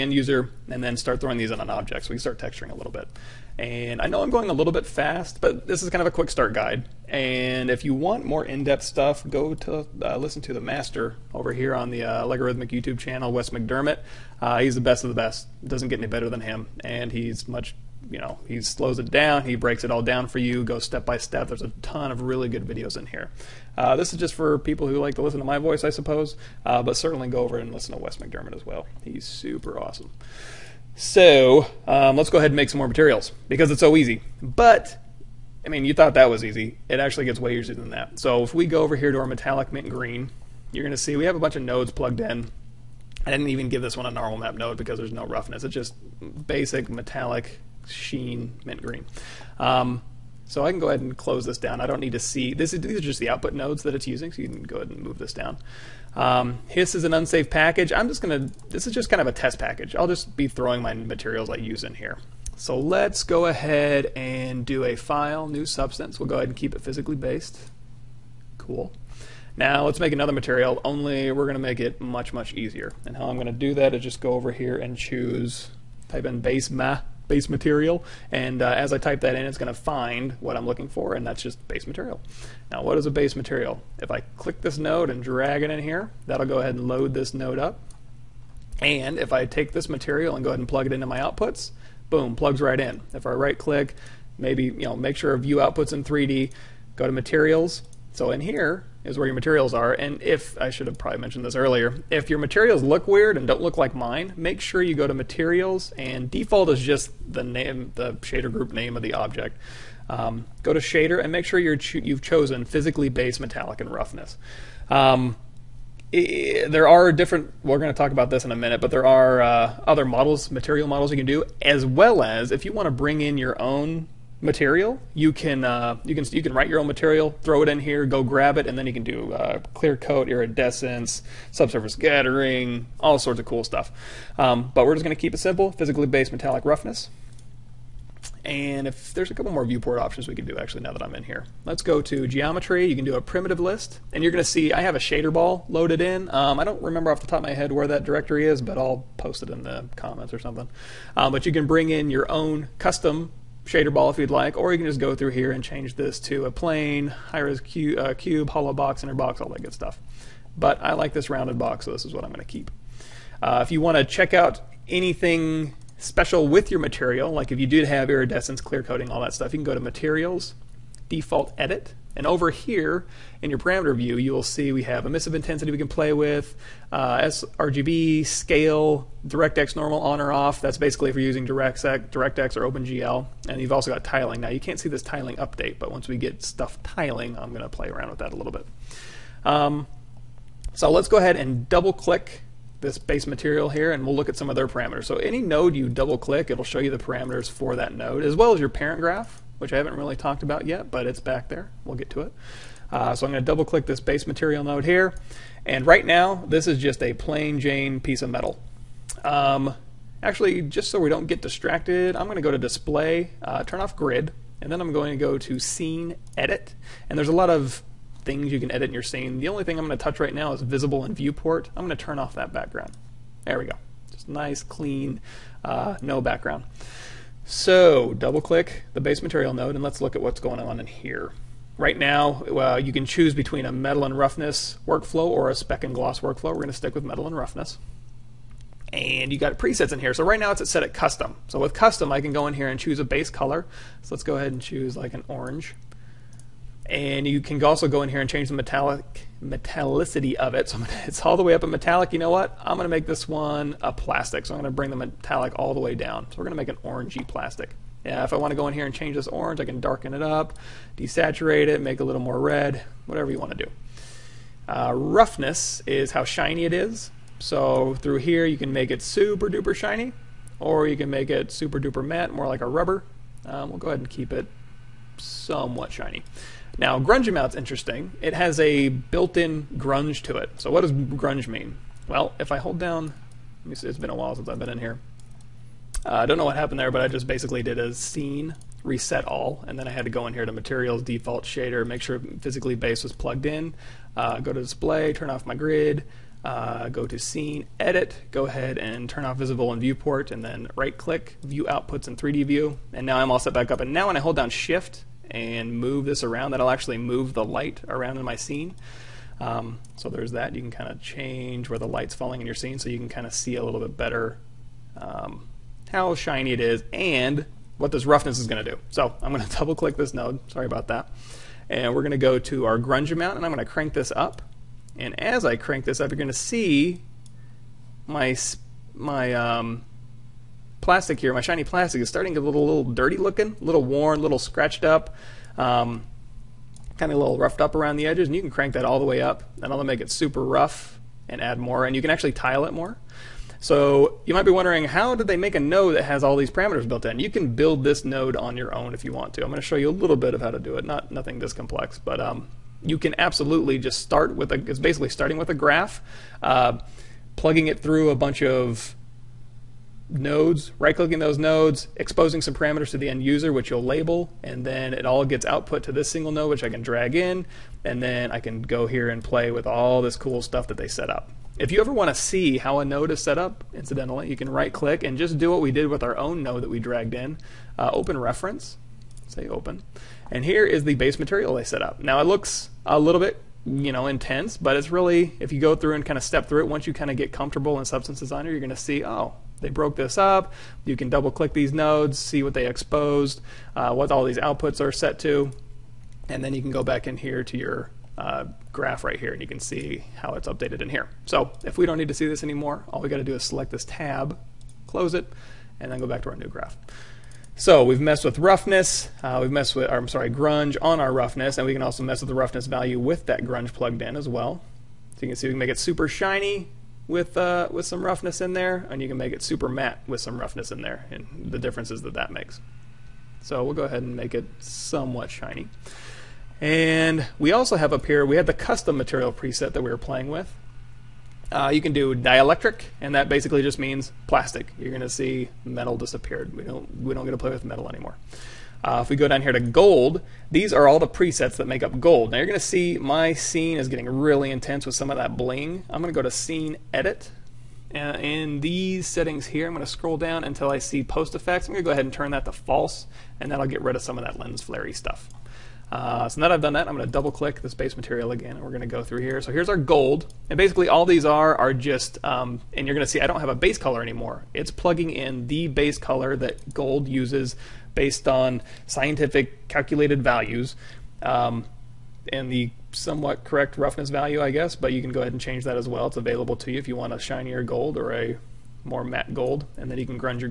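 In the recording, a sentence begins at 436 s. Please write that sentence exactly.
We don't we don't get to play with metal anymore.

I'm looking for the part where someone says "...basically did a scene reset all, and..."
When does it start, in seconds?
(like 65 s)
287 s.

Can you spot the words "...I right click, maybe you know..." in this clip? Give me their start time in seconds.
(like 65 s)
93 s.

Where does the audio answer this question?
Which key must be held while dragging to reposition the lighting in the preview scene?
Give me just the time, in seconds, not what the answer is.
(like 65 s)
304 s.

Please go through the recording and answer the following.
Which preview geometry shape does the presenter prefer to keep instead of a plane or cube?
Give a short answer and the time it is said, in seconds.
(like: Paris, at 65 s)
rounded box, at 161 s.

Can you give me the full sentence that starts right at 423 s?
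So we'll go ahead and make it somewhat shiny.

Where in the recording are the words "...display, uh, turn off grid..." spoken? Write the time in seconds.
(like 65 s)
212 s.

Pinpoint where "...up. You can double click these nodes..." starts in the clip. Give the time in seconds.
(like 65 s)
390 s.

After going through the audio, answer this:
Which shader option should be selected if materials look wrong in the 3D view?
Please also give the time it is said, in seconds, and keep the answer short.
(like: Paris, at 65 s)
physically based metallic and roughness, at 112 s.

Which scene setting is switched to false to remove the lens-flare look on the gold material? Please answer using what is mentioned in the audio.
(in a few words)
post effects.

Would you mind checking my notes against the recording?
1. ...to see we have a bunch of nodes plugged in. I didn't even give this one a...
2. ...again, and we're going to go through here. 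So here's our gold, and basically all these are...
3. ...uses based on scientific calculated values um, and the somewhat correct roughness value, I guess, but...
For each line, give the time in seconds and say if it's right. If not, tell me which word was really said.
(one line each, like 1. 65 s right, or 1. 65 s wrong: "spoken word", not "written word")
1. 40 s right
2. 458 s right
3. 467 s right.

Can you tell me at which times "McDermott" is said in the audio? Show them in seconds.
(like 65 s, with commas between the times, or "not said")
13 s, 28 s.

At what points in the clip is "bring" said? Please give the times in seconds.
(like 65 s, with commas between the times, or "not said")
122 s, 151 s, 254 s.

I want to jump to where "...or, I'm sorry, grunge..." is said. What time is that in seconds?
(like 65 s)
409 s.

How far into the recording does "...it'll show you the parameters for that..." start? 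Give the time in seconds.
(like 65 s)
196 s.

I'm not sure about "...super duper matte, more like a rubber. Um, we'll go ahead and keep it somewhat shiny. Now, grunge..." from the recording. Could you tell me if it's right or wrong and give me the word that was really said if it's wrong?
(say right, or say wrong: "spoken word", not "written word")
right.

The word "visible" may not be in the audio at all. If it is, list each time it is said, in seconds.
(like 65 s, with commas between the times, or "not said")
220 s, 299 s.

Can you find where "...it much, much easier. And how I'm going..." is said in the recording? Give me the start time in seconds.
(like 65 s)
71 s.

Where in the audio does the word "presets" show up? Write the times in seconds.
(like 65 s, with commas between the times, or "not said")
239 s, 429 s, 441 s.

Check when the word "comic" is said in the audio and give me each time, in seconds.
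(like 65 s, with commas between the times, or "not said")
not said.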